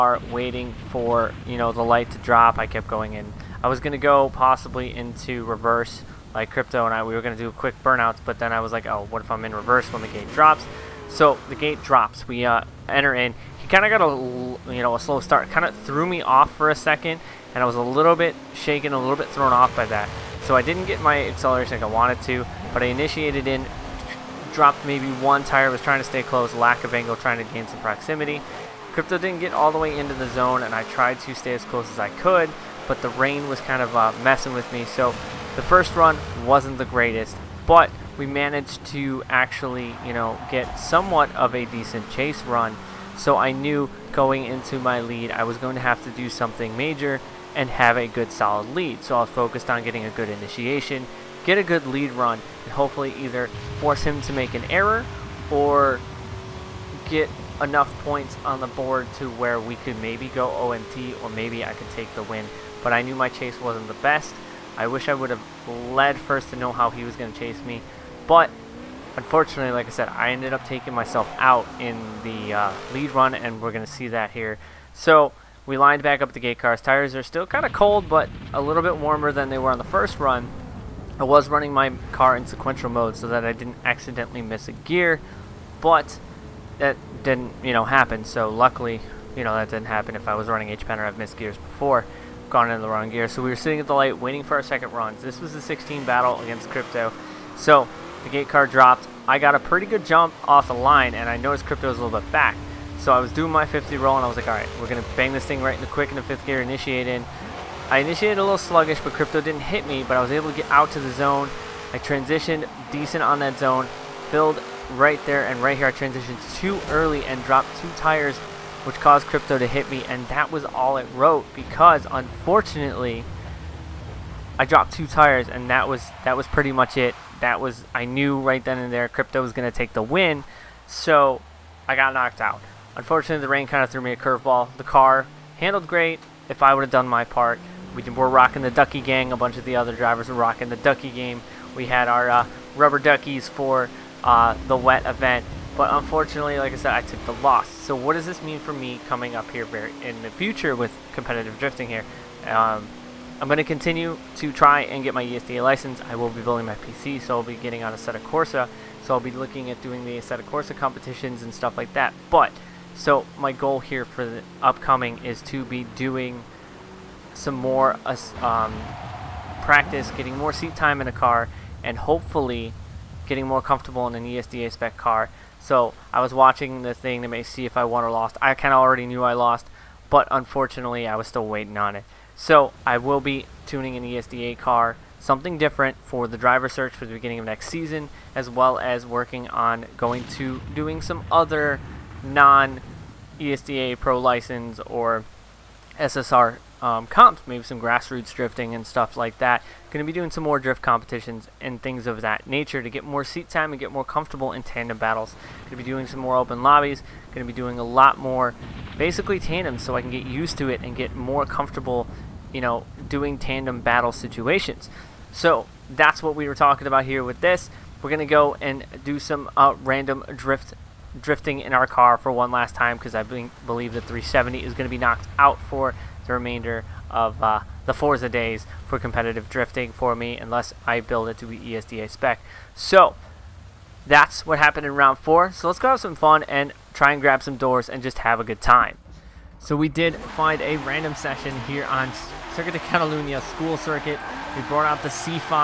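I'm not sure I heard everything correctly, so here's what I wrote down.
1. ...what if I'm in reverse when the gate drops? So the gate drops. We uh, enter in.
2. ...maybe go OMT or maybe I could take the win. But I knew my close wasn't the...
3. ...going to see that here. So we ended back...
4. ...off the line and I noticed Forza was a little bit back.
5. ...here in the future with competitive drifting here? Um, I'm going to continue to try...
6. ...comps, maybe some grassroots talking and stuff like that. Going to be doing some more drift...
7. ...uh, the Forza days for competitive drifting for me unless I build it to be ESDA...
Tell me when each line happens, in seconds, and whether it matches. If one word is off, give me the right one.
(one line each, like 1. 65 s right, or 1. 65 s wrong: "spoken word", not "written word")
1. 9 s right
2. 60 s wrong: "chase", not "close"
3. 73 s wrong: "lined", not "ended"
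4. 100 s wrong: "Crypto", not "Forza"
5. 149 s right
6. 197 s wrong: "drifting", not "talking"
7. 227 s right.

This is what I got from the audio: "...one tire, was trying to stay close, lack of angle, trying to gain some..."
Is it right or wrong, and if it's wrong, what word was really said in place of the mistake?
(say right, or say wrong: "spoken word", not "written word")
right.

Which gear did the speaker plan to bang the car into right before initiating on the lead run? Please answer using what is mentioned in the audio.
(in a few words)
Fifth gear.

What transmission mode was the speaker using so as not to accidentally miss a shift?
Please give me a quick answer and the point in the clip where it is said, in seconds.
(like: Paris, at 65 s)
Sequential mode, at 82 s.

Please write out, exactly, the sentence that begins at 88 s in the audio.
So luckily, you know, that didn't happen if I was running H-Pen or I've missed gears before gone into the wrong gear.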